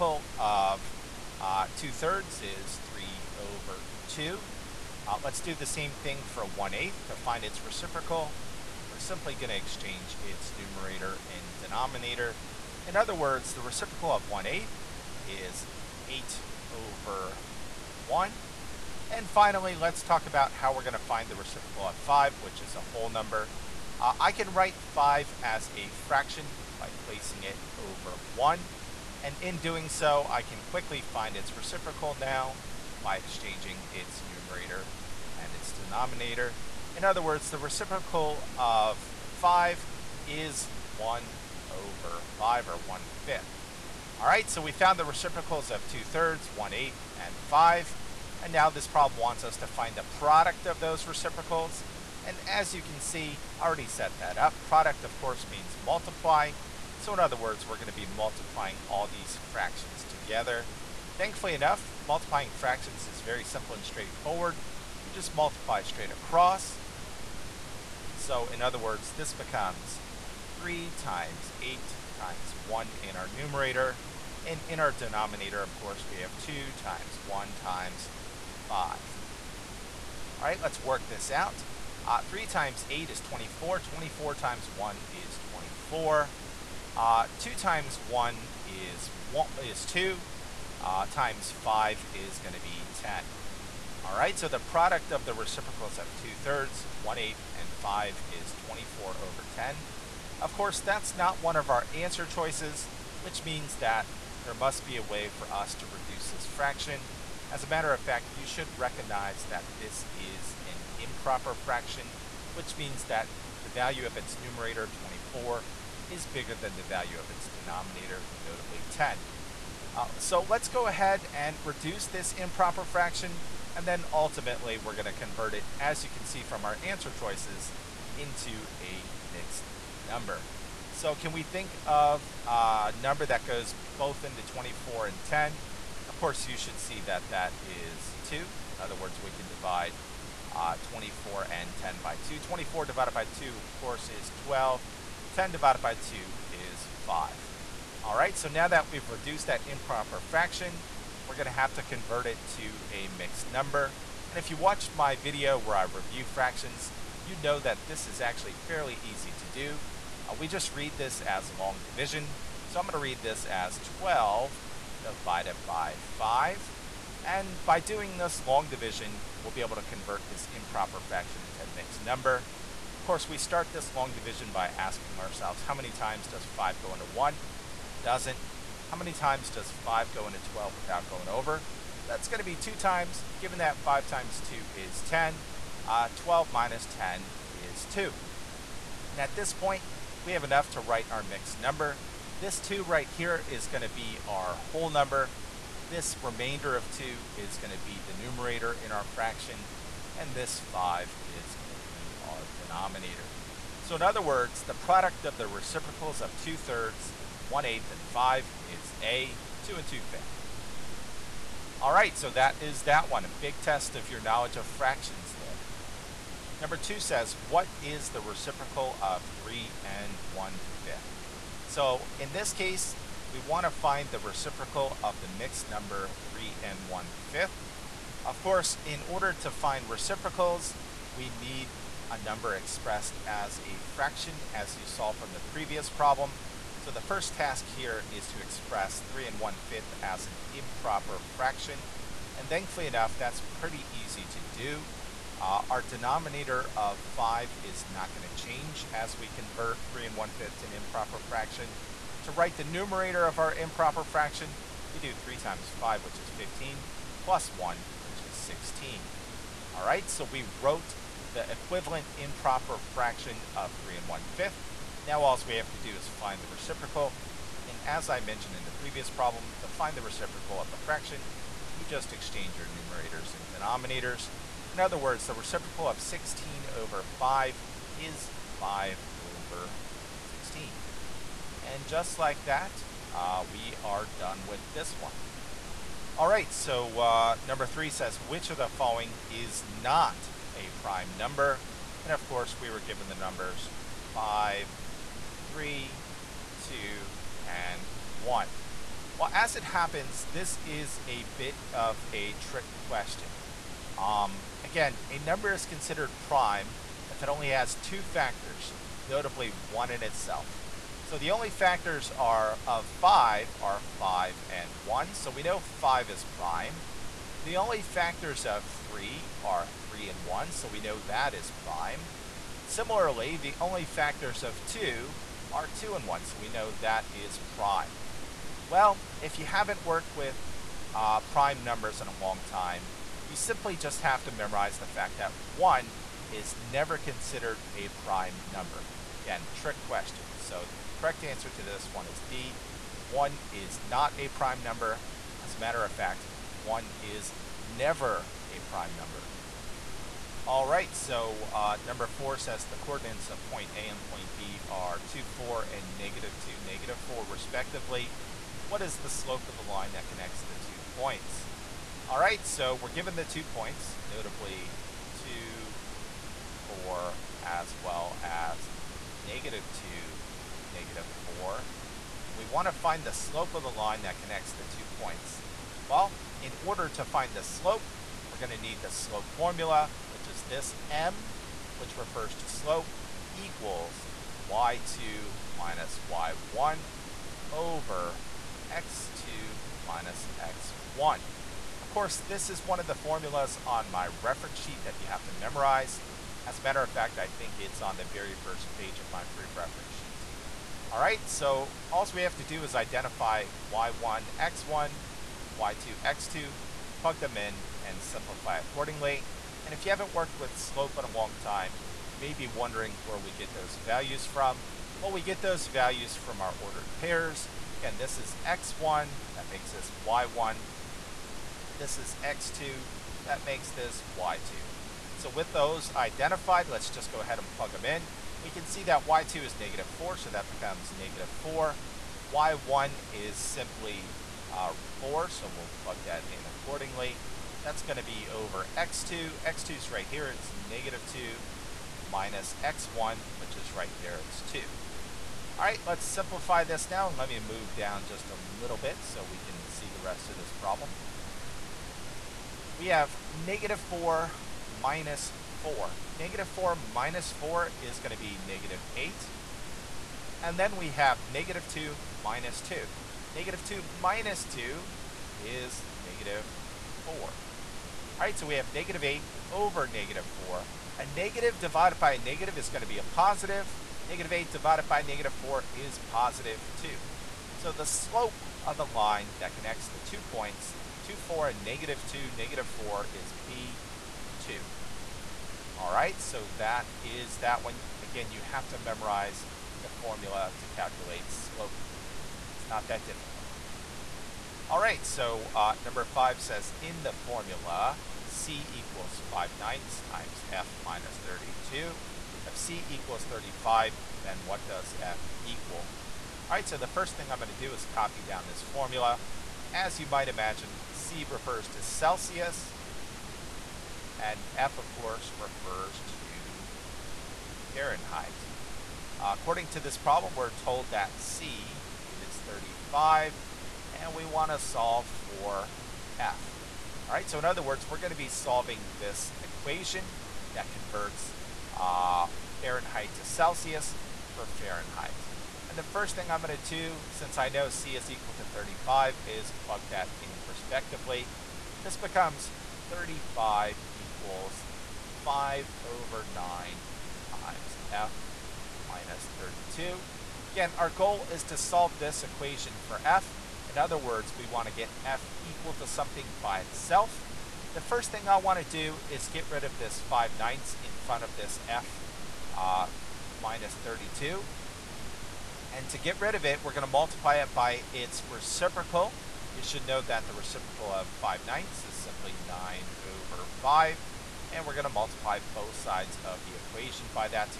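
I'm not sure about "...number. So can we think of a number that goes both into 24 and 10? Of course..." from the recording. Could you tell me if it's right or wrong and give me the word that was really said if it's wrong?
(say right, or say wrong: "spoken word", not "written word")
right.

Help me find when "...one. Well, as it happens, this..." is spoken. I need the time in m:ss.
4:58.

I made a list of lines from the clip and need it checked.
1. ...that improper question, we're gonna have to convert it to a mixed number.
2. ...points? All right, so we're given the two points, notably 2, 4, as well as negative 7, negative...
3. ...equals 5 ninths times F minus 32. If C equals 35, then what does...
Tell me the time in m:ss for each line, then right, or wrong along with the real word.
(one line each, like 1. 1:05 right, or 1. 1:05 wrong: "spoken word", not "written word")
1. 2:29 wrong: "fraction", not "question"
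2. 6:00 wrong: "2", not "7"
3. 8:18 right.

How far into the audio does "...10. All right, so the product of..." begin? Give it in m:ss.
1:32.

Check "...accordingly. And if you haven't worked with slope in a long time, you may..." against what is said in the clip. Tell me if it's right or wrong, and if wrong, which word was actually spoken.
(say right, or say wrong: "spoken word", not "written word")
right.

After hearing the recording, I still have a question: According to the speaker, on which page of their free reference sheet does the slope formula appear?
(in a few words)
the very first page.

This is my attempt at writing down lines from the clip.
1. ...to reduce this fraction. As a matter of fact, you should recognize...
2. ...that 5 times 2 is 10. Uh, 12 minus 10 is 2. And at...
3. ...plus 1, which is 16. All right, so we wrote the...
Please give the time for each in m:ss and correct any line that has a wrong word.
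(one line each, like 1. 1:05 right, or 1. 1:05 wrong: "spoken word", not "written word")
1. 1:45 right
2. 3:03 right
3. 4:17 right.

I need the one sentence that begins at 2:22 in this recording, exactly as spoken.
24 divided by 2, of course, is 12.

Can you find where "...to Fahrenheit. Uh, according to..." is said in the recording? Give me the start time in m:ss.
8:36.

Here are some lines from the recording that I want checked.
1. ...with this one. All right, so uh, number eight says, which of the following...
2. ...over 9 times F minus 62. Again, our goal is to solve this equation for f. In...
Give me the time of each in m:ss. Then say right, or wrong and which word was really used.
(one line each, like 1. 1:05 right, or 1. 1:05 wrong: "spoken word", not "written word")
1. 4:44 wrong: "three", not "eight"
2. 9:05 wrong: "32", not "62".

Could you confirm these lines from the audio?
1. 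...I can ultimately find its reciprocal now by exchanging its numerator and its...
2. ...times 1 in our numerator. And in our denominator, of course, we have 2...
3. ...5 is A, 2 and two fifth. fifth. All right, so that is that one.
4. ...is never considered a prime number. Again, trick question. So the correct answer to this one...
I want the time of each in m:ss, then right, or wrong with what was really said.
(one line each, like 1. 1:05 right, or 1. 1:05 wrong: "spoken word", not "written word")
1. 0:30 wrong: "quickly", not "ultimately"
2. 1:12 right
3. 3:28 right
4. 5:36 right.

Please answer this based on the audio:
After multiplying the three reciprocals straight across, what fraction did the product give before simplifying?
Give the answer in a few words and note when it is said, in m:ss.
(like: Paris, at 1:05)
24/10, at 1:38.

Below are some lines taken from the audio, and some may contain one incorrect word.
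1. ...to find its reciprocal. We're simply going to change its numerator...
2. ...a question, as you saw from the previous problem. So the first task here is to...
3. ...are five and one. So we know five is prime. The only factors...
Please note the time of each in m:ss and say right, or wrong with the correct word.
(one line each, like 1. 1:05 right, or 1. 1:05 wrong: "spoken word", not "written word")
1. 0:07 wrong: "exchange", not "change"
2. 3:53 wrong: "fraction", not "question"
3. 5:13 right.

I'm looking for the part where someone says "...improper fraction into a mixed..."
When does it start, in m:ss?
2:50.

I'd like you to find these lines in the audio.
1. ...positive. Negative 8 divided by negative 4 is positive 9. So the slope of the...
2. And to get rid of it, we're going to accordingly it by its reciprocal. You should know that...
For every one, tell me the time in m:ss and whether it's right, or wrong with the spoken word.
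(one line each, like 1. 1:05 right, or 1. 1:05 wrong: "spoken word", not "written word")
1. 7:53 wrong: "2", not "9"
2. 9:25 wrong: "multiply", not "accordingly".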